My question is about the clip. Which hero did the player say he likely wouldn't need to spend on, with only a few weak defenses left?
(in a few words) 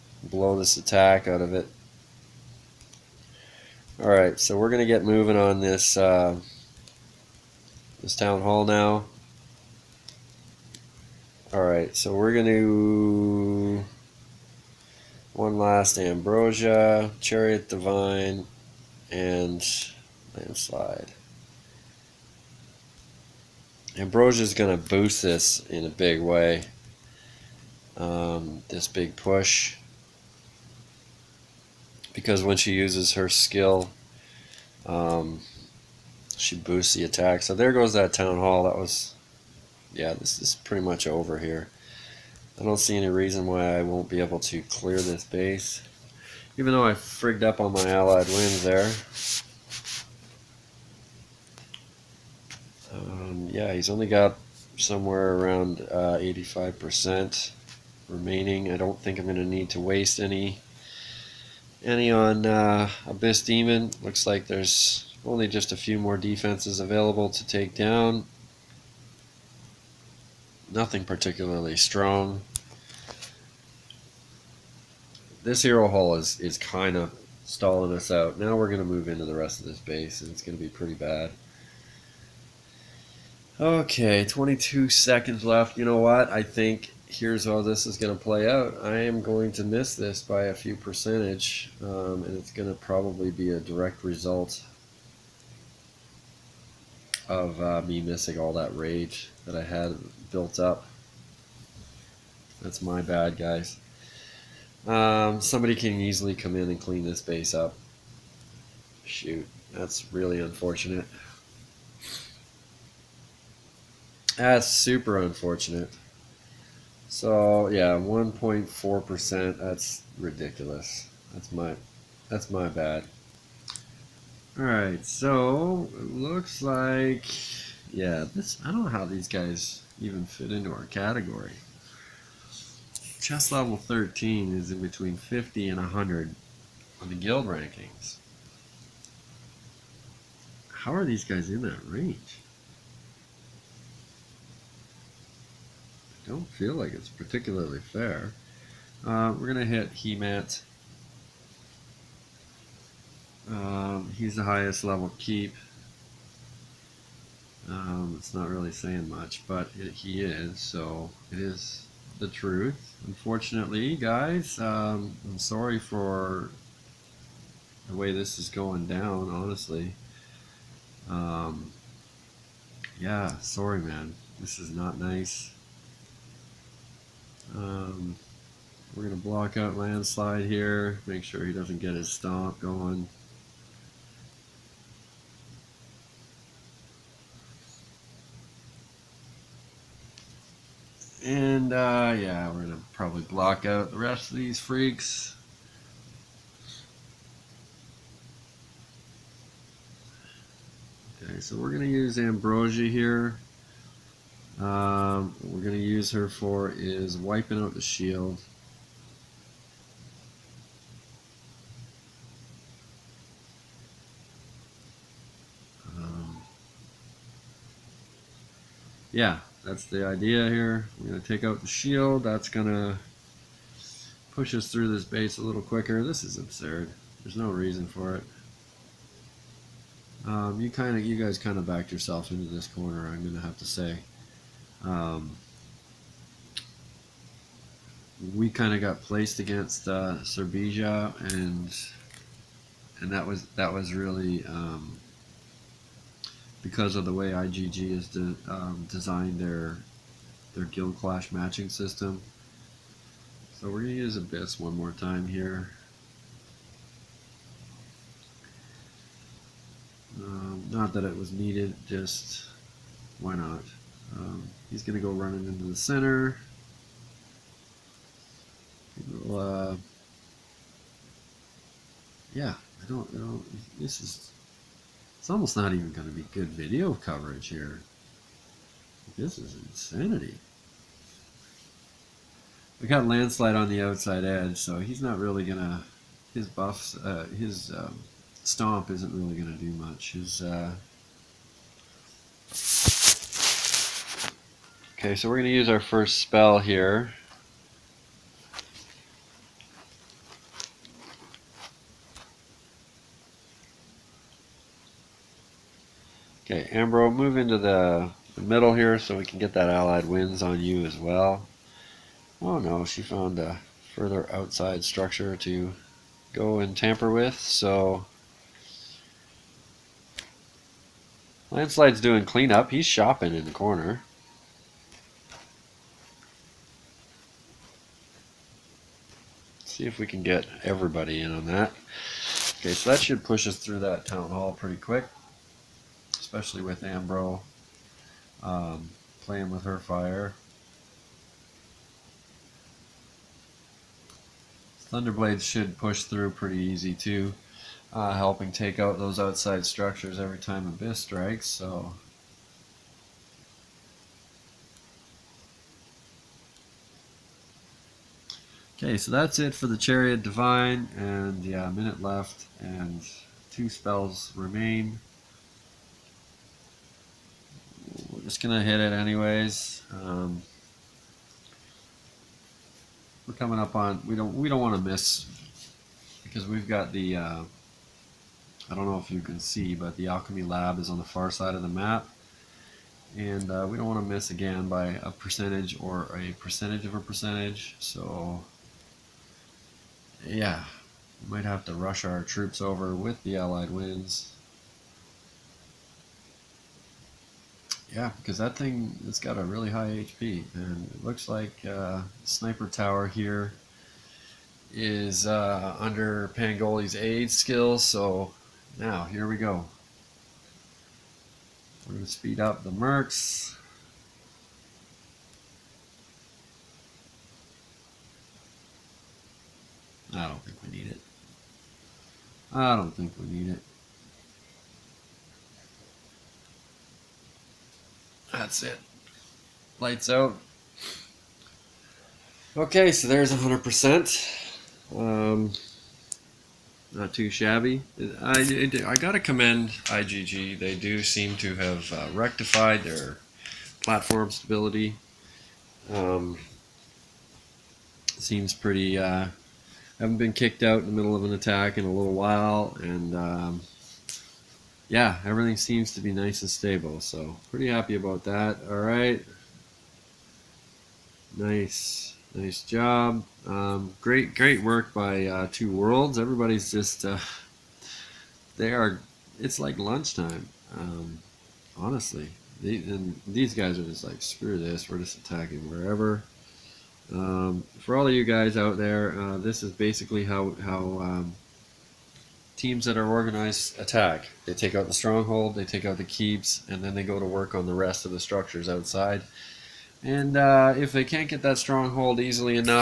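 Abyss Demon.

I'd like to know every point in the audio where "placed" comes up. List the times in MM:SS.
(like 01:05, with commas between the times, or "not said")
03:59.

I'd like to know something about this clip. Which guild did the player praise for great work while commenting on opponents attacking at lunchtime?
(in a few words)
Two Worlds.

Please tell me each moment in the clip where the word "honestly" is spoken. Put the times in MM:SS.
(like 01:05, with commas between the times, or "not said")
02:49, 07:51.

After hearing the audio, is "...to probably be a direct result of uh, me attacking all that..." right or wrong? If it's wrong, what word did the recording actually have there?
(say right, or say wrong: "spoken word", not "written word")
wrong: "missing", not "attacking".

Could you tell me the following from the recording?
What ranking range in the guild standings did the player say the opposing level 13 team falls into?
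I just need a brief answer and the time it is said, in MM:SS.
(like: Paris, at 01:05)
between 50 and 100, at 02:14.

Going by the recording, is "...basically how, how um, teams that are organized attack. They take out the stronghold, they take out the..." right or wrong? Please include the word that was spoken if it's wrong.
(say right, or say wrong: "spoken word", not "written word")
right.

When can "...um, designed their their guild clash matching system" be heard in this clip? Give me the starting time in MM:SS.
04:08.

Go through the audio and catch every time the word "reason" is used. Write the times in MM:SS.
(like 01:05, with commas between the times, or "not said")
00:43, 03:47.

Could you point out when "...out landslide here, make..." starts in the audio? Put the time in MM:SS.
02:59.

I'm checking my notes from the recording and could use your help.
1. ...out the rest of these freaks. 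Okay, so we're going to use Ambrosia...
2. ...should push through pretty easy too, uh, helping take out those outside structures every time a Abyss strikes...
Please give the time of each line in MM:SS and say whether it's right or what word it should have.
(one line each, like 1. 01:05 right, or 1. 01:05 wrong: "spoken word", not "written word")
1. 03:13 right
2. 05:45 right.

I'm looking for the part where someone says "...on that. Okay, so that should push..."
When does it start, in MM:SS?
05:31.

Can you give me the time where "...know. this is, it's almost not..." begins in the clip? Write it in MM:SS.
04:33.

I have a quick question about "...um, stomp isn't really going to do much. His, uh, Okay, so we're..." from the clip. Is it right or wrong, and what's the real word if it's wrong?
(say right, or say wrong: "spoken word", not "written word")
right.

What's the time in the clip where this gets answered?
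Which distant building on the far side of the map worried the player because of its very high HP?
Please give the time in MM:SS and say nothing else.
06:20.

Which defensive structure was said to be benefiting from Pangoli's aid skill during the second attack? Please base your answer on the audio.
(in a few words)
Sniper Tower.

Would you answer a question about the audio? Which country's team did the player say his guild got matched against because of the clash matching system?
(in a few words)
Serbia.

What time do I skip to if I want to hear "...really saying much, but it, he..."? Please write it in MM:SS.
02:38.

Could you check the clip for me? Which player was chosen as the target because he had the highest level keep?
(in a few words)
Hemat.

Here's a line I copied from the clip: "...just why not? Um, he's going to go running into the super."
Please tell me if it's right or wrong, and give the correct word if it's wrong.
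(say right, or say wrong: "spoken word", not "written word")
wrong: "center", not "super".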